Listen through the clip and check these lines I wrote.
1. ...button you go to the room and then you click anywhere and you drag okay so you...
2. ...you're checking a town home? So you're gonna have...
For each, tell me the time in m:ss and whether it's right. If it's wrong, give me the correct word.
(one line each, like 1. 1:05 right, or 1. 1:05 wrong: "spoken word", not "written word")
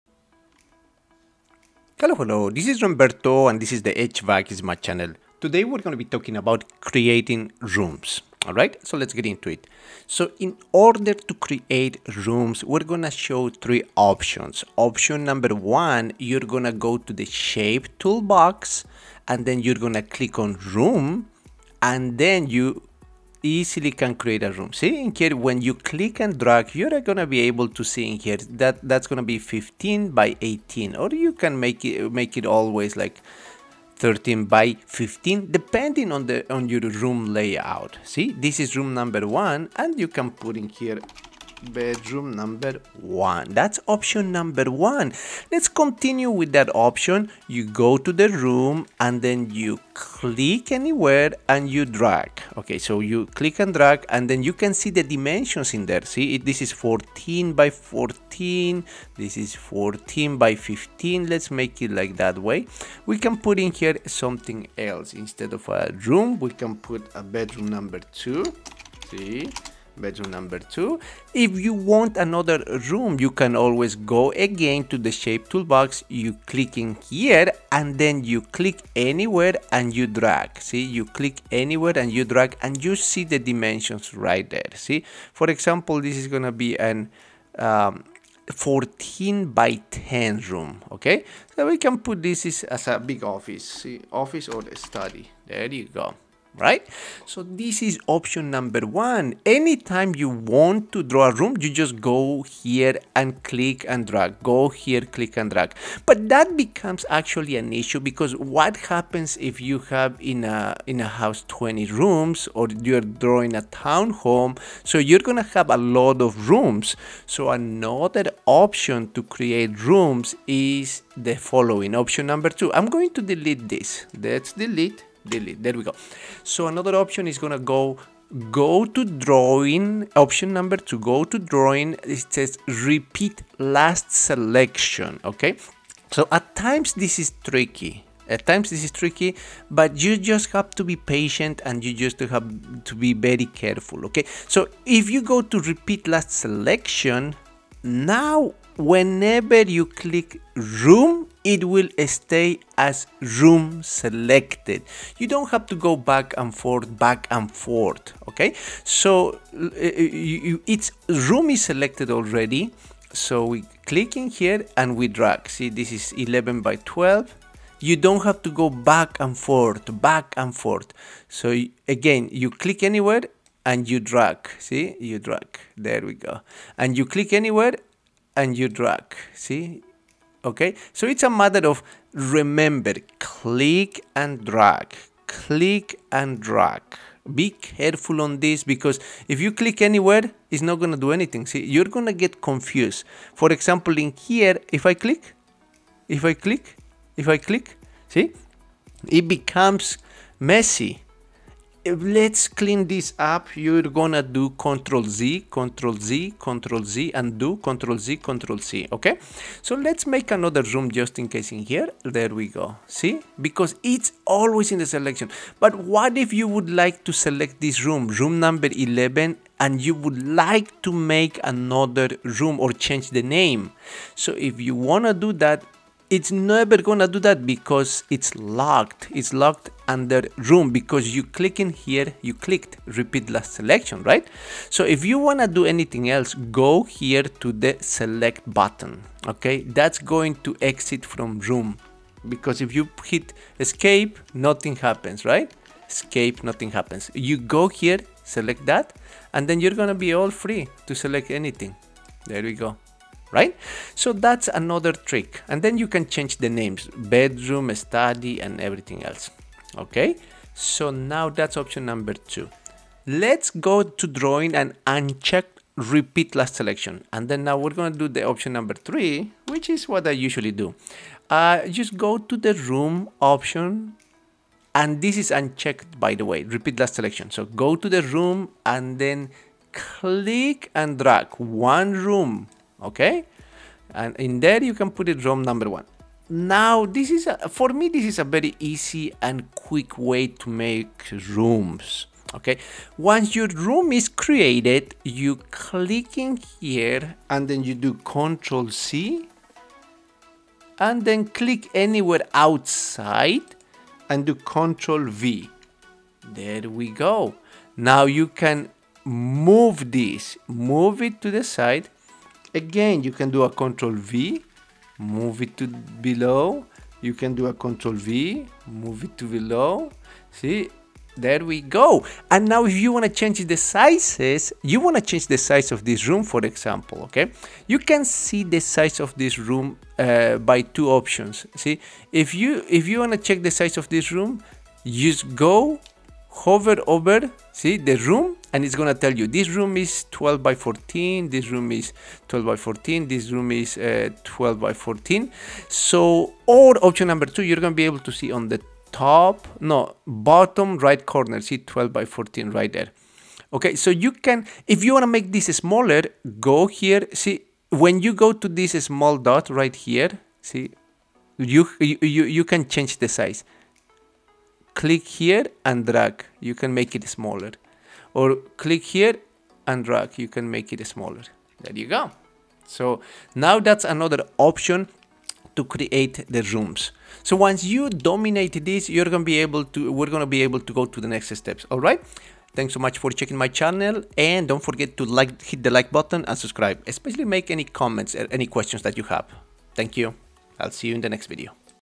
1. 0:46 wrong: "option", not "button"
2. 1:52 wrong: "drawing", not "checking".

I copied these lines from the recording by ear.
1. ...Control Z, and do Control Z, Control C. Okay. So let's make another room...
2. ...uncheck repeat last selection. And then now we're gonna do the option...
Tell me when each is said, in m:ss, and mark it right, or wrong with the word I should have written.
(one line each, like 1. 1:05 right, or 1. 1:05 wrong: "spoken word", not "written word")
1. 3:26 right
2. 4:24 right.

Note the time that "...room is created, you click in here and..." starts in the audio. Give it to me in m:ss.
4:53.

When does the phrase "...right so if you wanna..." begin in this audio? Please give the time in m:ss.
3:54.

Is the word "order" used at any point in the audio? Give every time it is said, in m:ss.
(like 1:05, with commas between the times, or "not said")
0:10.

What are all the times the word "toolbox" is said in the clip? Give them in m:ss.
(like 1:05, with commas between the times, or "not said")
0:17, 1:15.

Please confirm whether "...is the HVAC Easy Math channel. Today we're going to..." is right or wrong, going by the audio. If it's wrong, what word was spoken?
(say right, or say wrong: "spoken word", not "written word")
right.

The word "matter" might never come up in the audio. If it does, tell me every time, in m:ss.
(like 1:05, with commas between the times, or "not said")
3:01.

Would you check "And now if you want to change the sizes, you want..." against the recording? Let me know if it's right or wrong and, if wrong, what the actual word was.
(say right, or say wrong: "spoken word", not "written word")
right.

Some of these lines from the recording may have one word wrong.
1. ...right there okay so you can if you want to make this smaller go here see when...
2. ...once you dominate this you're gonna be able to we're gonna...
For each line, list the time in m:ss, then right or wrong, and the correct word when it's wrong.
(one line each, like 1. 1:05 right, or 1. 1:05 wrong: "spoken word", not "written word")
1. 5:52 right
2. 6:17 right.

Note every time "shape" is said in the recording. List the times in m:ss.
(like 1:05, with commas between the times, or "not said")
0:17, 1:15.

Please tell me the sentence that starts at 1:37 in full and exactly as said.
So this is option number one.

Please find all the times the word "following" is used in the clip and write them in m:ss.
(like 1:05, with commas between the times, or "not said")
2:01.